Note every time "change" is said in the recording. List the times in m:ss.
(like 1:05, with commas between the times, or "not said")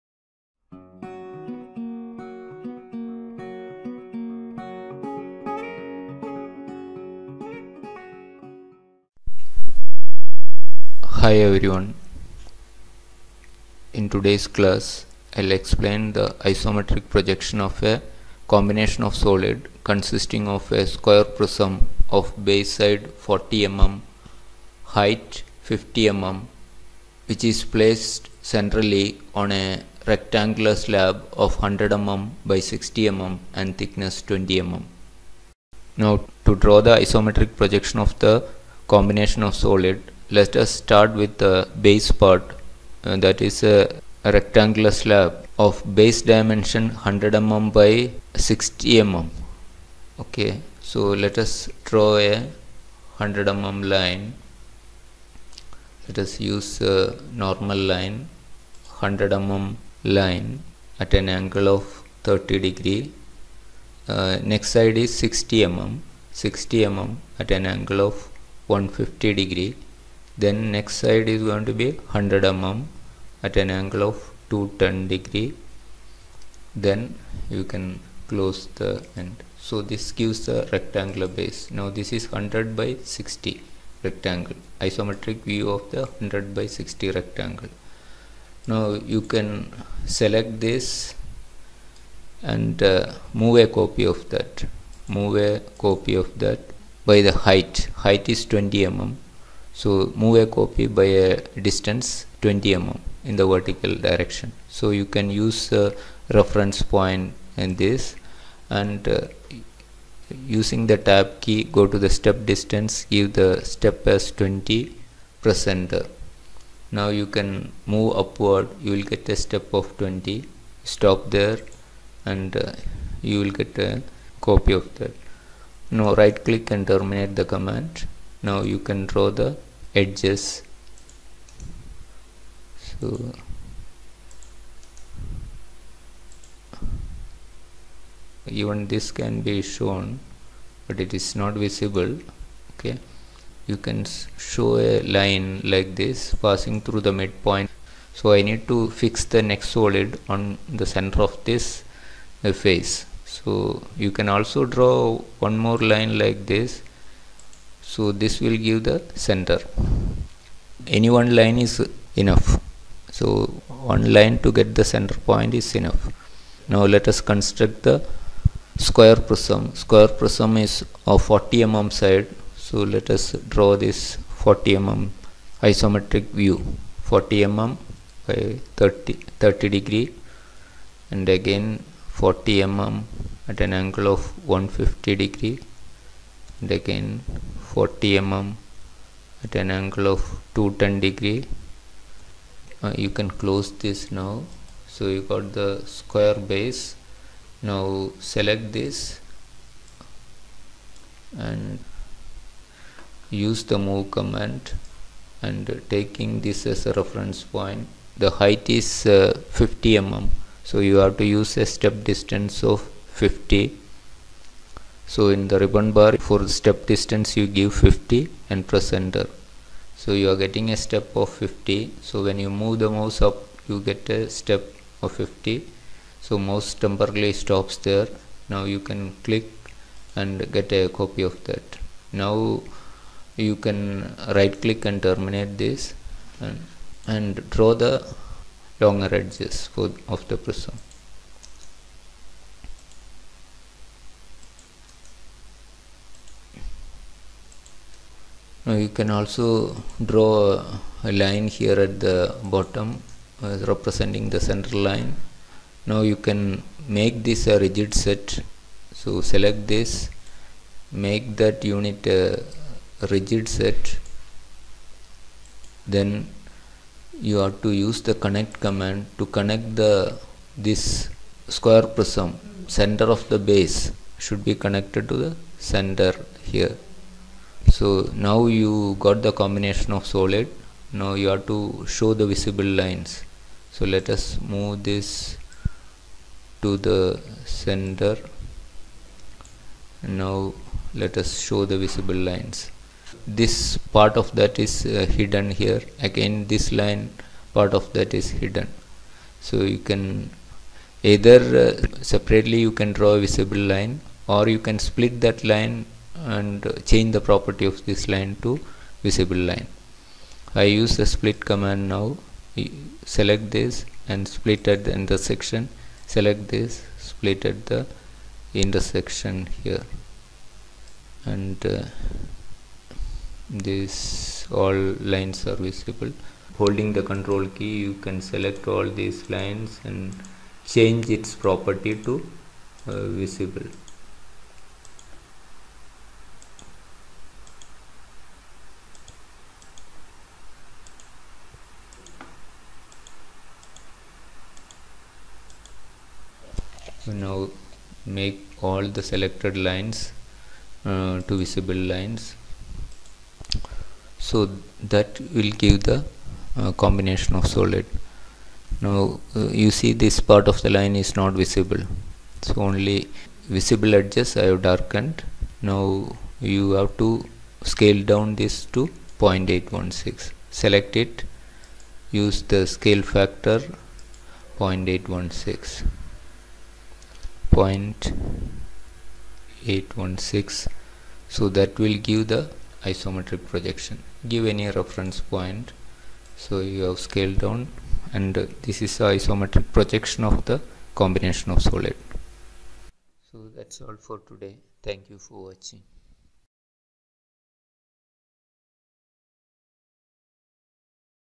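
5:06, 5:30.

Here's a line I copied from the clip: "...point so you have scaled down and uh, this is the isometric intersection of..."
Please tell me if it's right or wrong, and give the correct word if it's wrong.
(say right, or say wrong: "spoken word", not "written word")
wrong: "projection", not "intersection".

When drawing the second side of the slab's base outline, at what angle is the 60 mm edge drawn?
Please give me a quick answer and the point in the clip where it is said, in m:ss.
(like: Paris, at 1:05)
150 degrees, at 1:06.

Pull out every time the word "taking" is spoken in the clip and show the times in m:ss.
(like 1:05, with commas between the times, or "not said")
3:25.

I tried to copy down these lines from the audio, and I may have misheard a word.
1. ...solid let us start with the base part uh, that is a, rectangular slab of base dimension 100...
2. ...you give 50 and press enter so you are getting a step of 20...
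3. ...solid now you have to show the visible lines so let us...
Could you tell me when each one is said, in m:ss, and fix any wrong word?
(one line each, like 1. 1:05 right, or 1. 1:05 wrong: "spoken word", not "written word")
1. 0:39 right
2. 3:37 wrong: "50", not "20"
3. 4:40 right.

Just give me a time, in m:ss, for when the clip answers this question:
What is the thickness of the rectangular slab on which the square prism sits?
0:33.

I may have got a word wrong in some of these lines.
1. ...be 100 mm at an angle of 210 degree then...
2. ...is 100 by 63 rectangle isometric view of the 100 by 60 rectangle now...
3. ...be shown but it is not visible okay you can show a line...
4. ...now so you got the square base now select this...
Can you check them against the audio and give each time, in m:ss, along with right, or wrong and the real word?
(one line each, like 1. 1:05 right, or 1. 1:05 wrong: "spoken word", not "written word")
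1. 1:11 right
2. 1:22 wrong: "60", not "63"
3. 2:19 right
4. 3:14 right.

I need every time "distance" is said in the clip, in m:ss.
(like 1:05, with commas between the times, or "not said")
1:41, 1:52, 3:32, 3:36.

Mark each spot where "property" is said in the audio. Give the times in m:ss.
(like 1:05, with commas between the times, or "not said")
5:07, 5:31.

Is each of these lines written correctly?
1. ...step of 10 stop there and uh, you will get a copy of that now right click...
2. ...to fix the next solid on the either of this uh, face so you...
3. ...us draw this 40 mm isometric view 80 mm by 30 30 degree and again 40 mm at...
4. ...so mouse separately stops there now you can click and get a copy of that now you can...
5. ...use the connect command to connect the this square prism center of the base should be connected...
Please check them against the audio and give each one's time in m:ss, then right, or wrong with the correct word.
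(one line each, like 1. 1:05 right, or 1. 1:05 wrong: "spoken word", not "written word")
1. 1:59 wrong: "20", not "10"
2. 2:28 wrong: "center", not "either"
3. 2:53 wrong: "40", not "80"
4. 3:46 wrong: "temporarily", not "separately"
5. 4:27 right.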